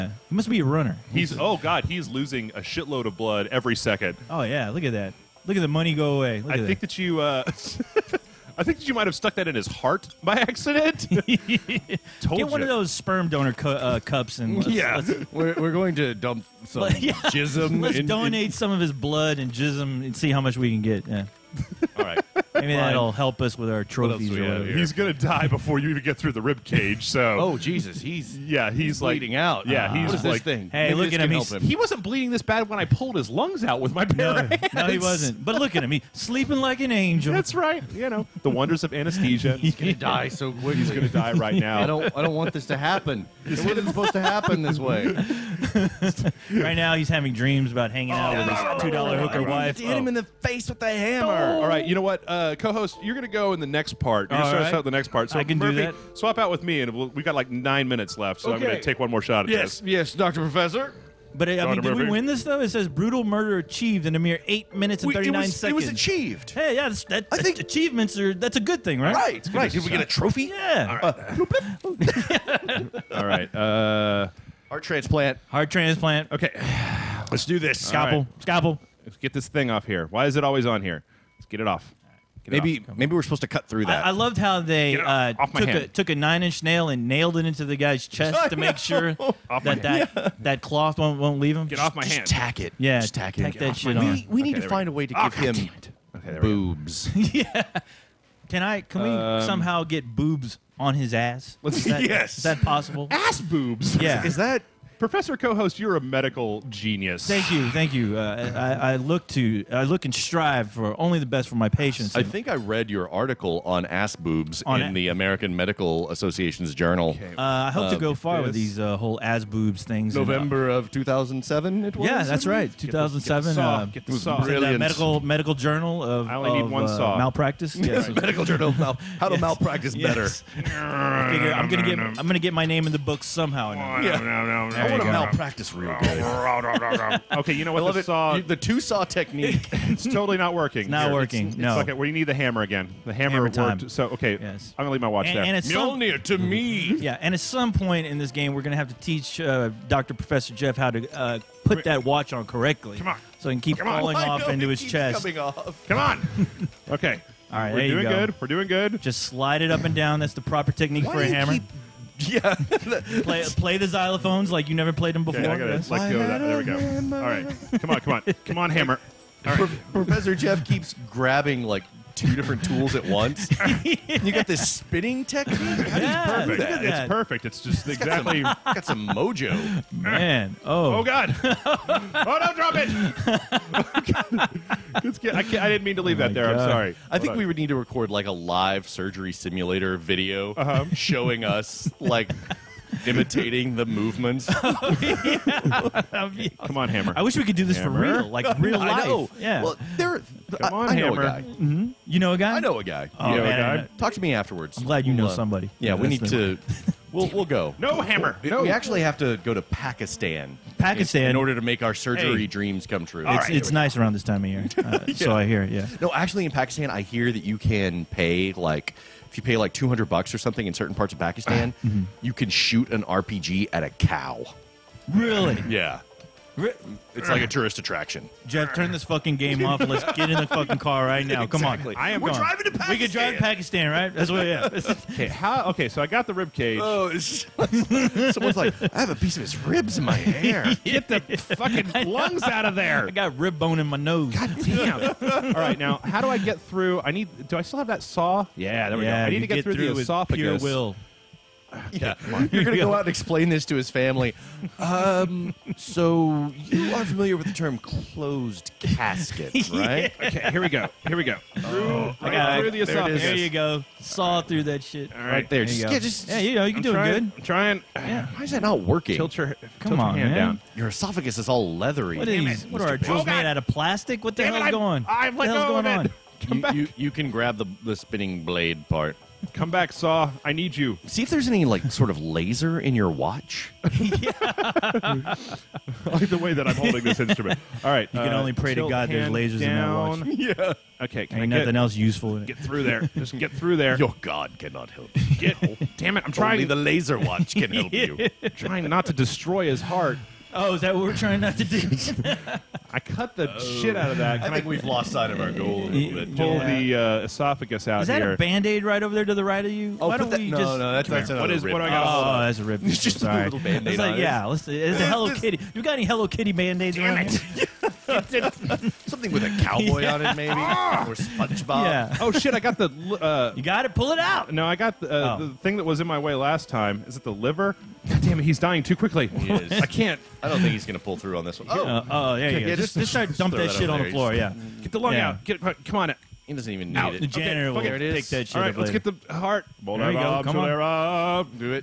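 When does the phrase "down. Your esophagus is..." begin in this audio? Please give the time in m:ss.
4:30.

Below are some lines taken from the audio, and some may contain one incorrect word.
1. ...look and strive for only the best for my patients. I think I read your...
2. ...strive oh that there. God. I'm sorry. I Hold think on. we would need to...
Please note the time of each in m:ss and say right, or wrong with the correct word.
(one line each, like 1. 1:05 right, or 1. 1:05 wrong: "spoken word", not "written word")
1. 1:49 right
2. 3:06 wrong: "leave", not "strive".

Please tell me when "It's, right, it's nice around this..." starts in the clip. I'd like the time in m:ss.
3:33.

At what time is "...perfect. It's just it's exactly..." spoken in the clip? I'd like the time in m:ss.
2:57.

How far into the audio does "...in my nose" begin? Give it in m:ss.
4:03.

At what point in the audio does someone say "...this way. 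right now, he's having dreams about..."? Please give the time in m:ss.
0:44.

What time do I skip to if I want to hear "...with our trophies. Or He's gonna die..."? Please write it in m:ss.
0:23.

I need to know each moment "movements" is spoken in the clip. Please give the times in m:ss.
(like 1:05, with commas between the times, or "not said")
3:13.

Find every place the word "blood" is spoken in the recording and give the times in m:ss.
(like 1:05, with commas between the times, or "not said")
0:03, 0:18.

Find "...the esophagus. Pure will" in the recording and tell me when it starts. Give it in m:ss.
4:09.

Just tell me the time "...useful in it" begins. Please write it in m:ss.
4:51.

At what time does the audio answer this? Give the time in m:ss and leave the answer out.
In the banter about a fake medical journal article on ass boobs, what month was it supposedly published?
2:00.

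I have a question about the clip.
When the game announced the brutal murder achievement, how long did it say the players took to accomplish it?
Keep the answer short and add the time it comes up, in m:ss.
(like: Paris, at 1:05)
8 minutes 39 seconds, at 1:04.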